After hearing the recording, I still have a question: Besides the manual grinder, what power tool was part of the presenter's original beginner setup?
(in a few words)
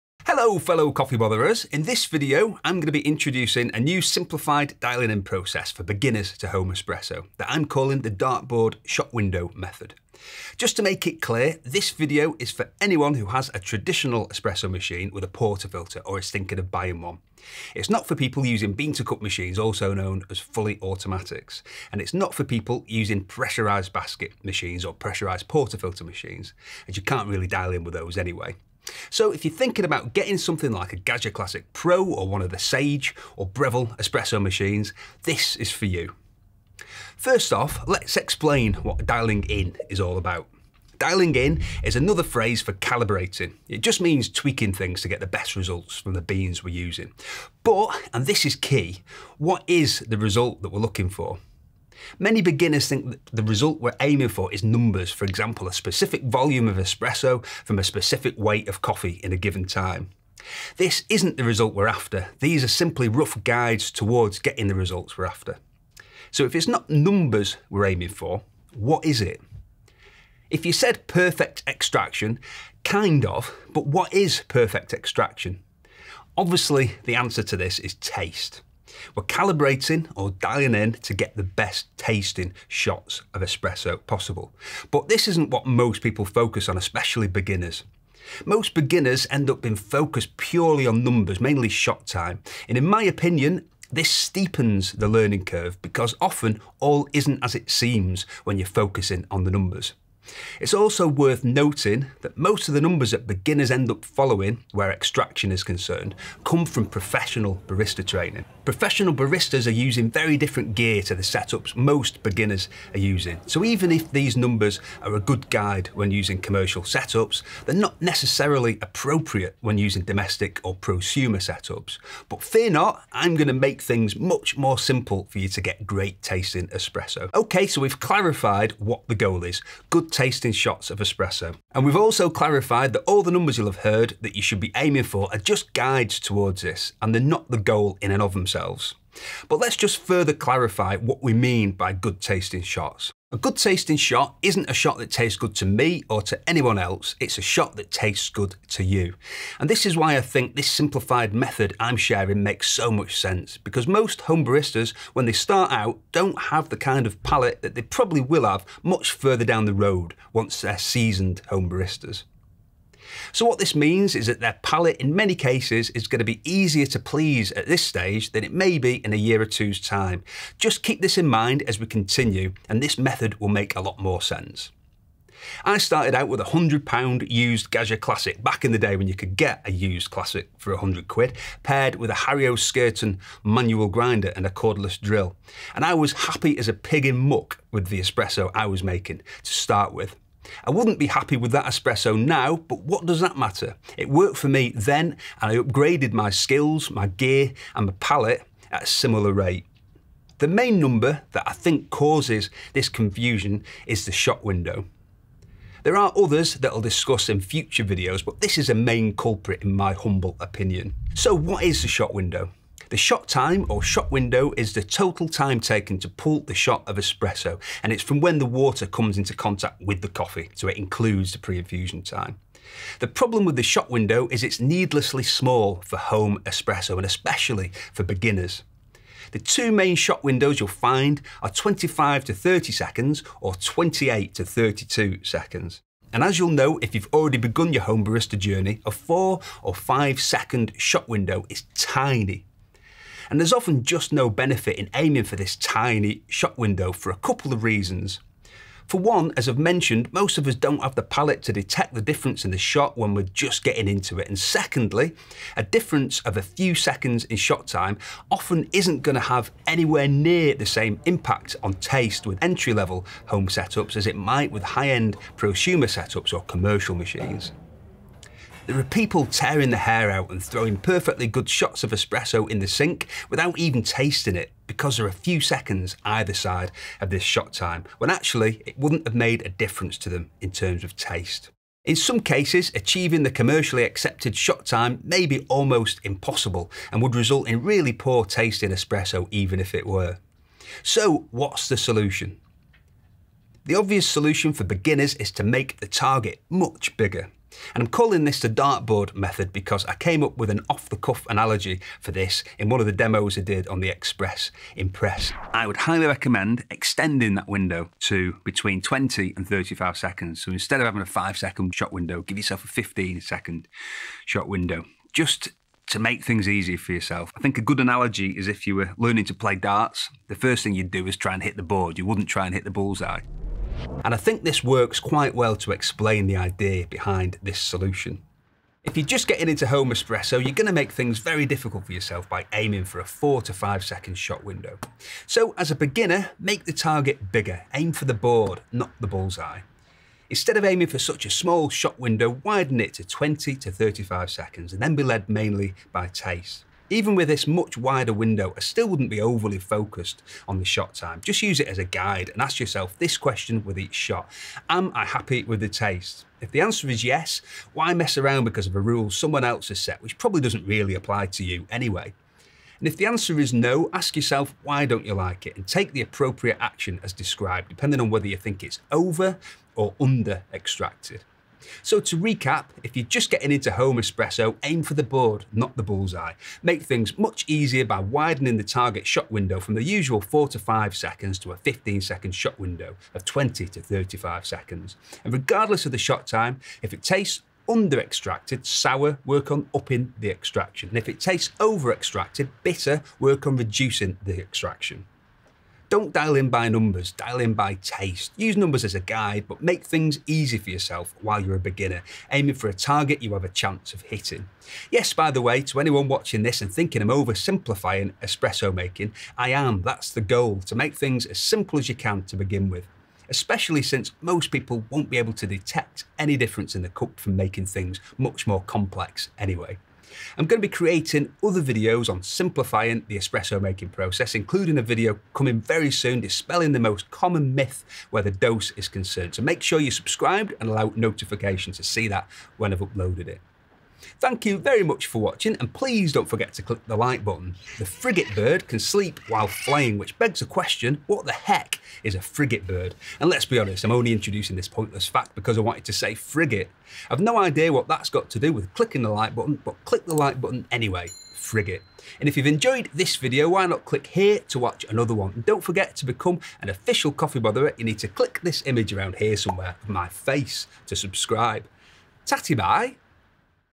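cordless drill.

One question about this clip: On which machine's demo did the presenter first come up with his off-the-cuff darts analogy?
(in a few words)
Express Impress.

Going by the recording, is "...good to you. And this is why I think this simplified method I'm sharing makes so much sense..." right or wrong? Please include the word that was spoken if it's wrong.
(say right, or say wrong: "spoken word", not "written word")
right.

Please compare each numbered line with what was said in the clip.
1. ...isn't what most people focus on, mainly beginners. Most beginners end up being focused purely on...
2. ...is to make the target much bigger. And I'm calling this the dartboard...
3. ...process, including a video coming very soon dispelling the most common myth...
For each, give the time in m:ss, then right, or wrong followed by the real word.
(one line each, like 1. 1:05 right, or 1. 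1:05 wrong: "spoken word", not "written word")
1. 1:25 wrong: "especially", not "mainly"
2. 4:55 right
3. 7:03 right.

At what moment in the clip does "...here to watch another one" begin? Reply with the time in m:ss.
7:34.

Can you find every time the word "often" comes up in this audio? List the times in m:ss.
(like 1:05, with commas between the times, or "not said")
1:36, 4:03, 4:18.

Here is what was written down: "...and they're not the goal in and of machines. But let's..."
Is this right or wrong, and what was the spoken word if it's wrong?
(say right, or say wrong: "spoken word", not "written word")
wrong: "themselves", not "machines".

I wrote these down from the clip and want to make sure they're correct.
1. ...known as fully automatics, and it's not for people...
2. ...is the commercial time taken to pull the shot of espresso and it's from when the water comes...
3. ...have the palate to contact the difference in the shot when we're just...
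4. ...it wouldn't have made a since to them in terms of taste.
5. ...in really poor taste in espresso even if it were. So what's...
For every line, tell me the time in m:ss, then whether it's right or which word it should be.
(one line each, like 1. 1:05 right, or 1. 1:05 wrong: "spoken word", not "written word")
1. 0:19 right
2. 3:34 wrong: "total", not "commercial"
3. 4:10 wrong: "detect", not "contact"
4. 4:38 wrong: "difference", not "since"
5. 4:47 right.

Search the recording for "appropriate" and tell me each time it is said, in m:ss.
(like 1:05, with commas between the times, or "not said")
1:58, 6:06.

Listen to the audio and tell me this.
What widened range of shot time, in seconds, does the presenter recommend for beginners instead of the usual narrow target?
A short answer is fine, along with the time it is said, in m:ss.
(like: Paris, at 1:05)
20 to 35 seconds, at 5:08.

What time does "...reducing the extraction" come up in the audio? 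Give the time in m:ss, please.
6:33.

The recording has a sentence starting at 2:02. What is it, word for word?
But fear not, I'm going to make things much more simple for you to get great tasting espresso.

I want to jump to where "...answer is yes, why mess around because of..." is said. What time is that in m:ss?
5:56.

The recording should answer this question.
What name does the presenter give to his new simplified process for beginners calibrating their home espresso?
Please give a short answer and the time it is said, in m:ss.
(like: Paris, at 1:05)
dartboard shot window method, at 0:08.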